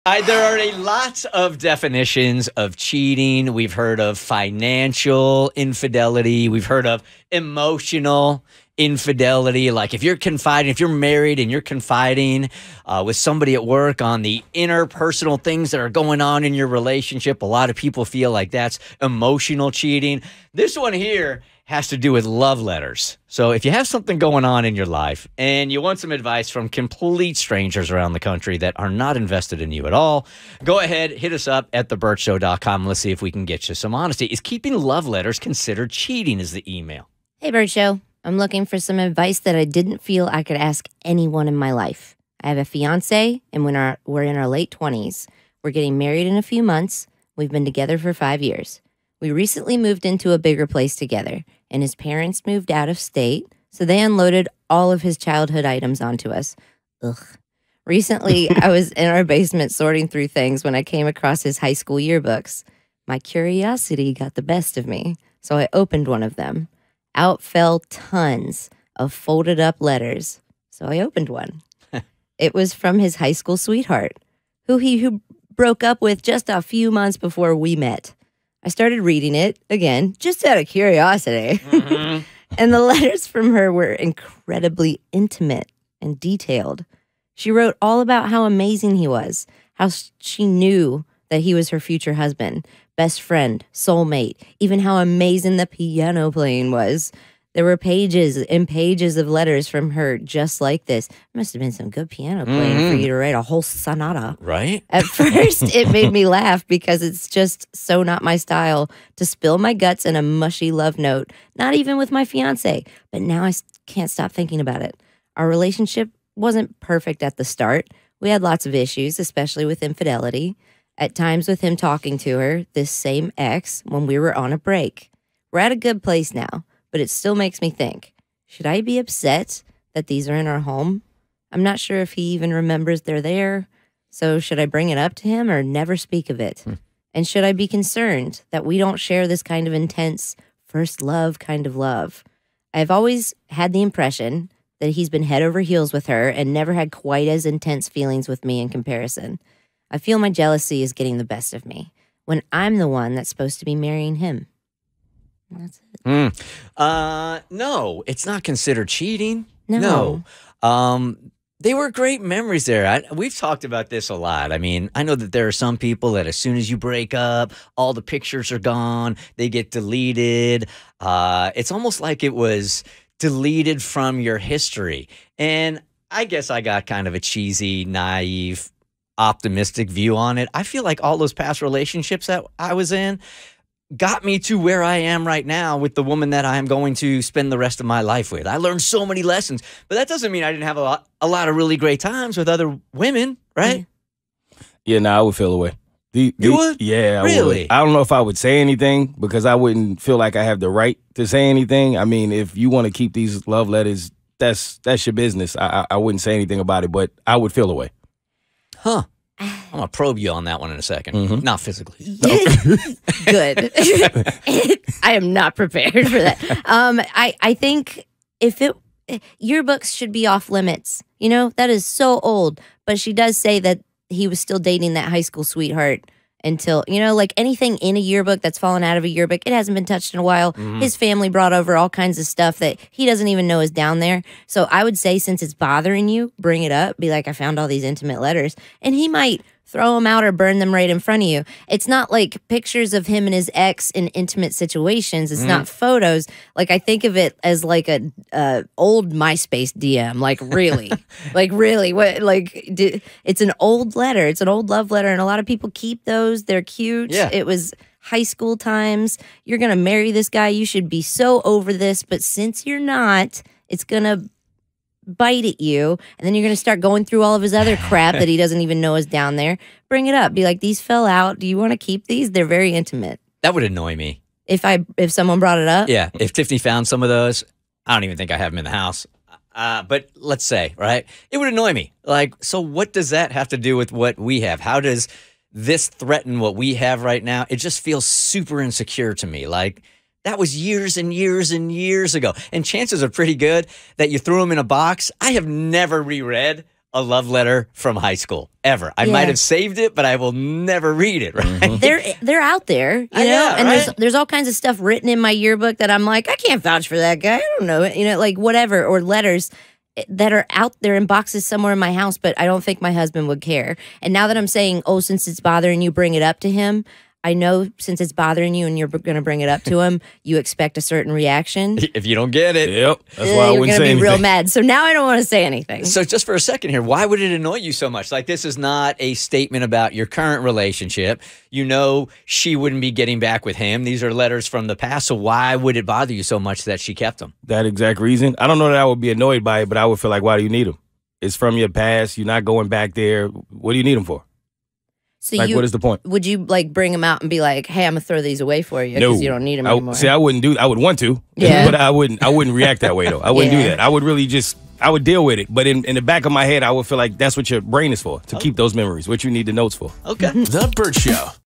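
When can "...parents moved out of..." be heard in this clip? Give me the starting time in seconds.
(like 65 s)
51 s.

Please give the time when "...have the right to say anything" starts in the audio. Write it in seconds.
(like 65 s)
200 s.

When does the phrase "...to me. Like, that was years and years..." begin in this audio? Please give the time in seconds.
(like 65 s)
289 s.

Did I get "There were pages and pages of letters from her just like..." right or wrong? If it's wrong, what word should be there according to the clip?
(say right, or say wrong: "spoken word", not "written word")
right.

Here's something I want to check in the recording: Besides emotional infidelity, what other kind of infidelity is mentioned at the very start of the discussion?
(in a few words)
Financial infidelity.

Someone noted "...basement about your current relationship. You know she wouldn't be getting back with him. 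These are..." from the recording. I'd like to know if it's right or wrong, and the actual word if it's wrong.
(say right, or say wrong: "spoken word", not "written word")
wrong: "statement", not "basement".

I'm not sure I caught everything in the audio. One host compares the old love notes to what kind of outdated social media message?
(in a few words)
Old MySpace DM.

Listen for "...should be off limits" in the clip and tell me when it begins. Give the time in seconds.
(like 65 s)
219 s.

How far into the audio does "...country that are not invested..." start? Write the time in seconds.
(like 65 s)
28 s.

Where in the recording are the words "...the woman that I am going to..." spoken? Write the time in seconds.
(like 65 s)
185 s.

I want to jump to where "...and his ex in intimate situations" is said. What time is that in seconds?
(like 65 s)
243 s.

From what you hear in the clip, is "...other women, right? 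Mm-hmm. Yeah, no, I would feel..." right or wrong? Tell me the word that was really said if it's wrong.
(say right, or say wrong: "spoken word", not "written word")
right.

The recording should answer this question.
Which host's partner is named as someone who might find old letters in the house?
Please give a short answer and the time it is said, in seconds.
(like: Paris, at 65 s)
Tiffany, at 276 s.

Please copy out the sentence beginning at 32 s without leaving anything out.
Let's see if we can get you some honesty.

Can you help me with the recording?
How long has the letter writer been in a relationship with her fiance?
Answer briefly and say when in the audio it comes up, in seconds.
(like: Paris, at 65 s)
5 years, at 48 s.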